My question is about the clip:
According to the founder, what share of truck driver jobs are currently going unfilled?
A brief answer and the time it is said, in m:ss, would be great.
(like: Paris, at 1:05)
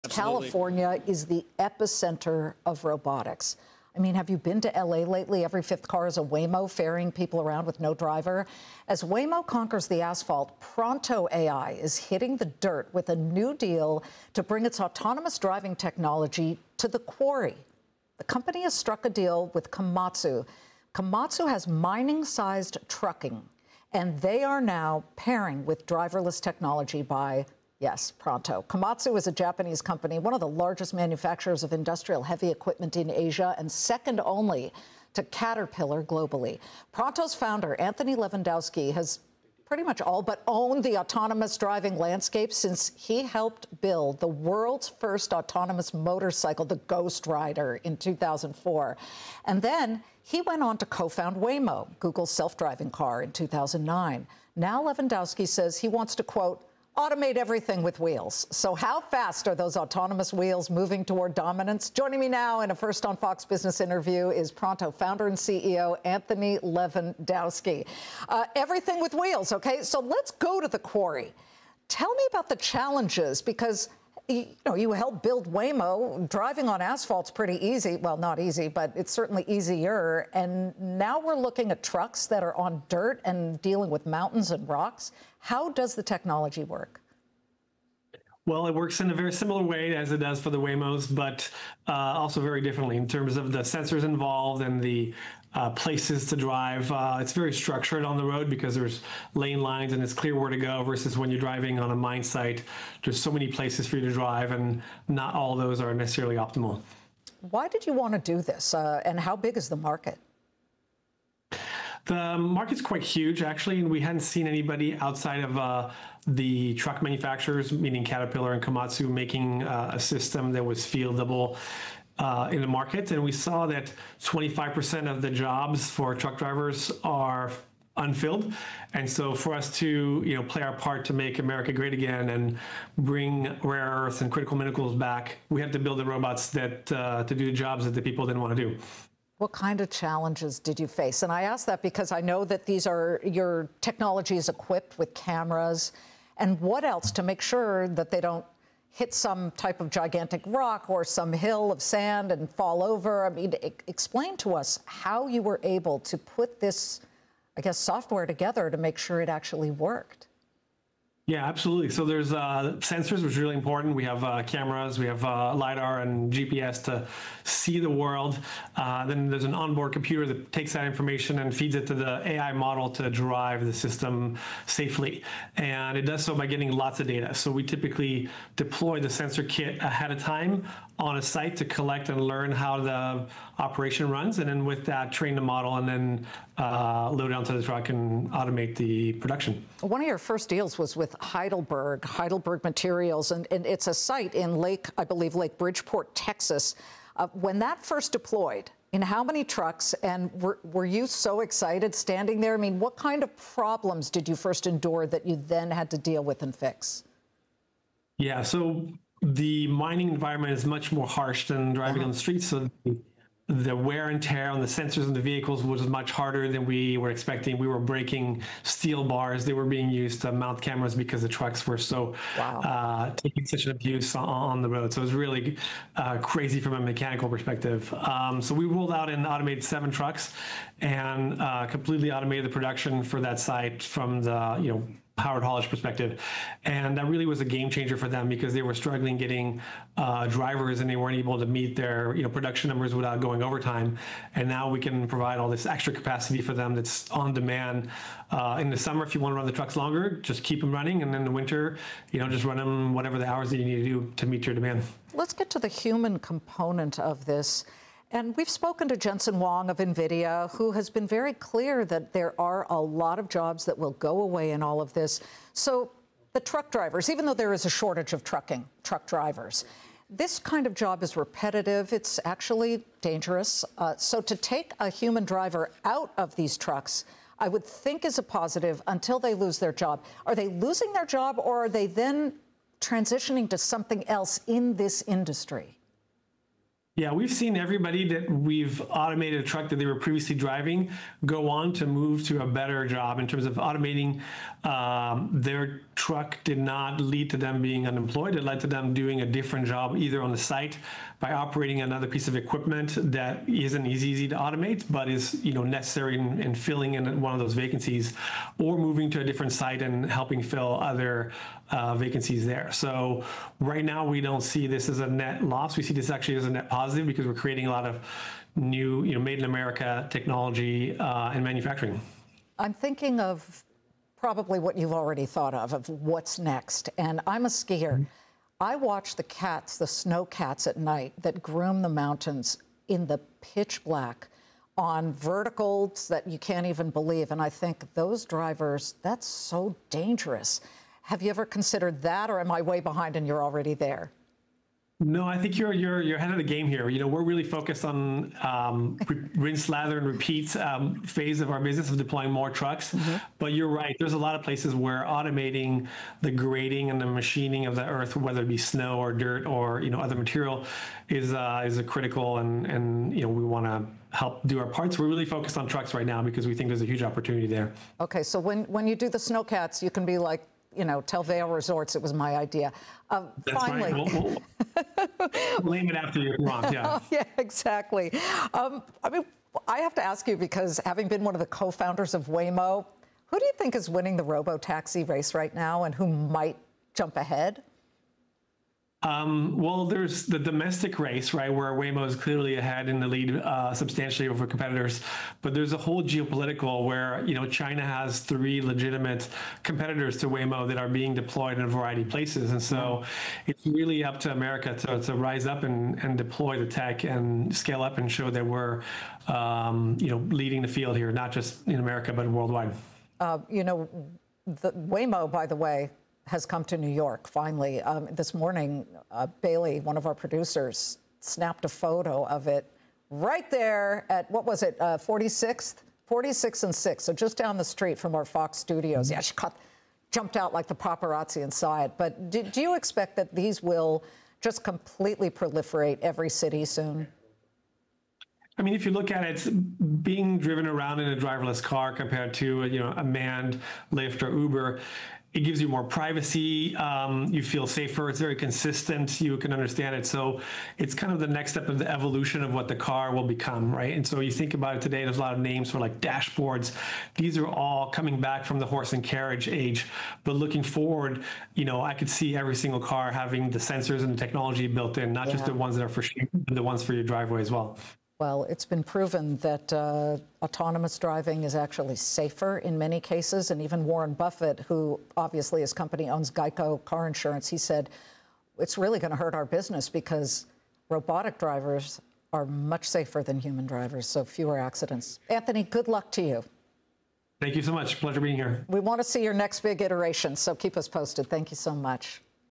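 25%, at 2:04.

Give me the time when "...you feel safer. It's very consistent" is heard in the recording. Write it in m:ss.
7:27.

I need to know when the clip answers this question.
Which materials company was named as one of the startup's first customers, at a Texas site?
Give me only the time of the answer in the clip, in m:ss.
3:12.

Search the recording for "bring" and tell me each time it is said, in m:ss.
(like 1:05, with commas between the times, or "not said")
0:14, 2:12.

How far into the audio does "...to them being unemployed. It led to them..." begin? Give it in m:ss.
4:57.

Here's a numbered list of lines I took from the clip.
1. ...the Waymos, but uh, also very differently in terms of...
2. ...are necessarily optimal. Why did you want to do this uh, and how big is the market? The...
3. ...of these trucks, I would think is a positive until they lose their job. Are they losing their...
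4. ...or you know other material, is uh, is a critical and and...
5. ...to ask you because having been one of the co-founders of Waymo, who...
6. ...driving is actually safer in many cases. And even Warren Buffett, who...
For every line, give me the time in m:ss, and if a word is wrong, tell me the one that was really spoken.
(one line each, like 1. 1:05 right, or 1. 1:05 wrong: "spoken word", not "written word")
1. 1:30 right
2. 1:45 right
3. 4:36 right
4. 5:59 right
5. 6:19 right
6. 7:50 right.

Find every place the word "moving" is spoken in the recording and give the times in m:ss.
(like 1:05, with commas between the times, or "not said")
1:00, 5:08.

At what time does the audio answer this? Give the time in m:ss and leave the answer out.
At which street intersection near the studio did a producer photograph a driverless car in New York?
7:06.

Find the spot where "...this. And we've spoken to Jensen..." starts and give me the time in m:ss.
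4:17.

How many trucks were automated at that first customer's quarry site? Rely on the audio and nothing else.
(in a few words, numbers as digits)
7.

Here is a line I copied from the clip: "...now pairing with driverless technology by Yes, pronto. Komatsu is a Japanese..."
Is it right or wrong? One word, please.
right.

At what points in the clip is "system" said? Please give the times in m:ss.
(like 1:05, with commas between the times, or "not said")
1:59, 2:53.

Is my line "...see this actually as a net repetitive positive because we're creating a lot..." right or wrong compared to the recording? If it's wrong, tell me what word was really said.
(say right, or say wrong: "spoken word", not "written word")
wrong: "positive", not "repetitive".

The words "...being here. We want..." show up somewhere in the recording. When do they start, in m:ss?
8:08.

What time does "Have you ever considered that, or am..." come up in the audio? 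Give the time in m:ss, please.
5:41.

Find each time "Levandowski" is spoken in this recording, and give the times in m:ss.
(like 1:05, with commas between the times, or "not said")
0:38, 0:54, 1:06.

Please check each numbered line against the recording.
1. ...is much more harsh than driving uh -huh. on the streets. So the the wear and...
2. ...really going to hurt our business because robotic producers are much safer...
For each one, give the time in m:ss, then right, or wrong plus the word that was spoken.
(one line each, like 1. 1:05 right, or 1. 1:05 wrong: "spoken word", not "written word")
1. 3:30 right
2. 7:58 wrong: "drivers", not "producers".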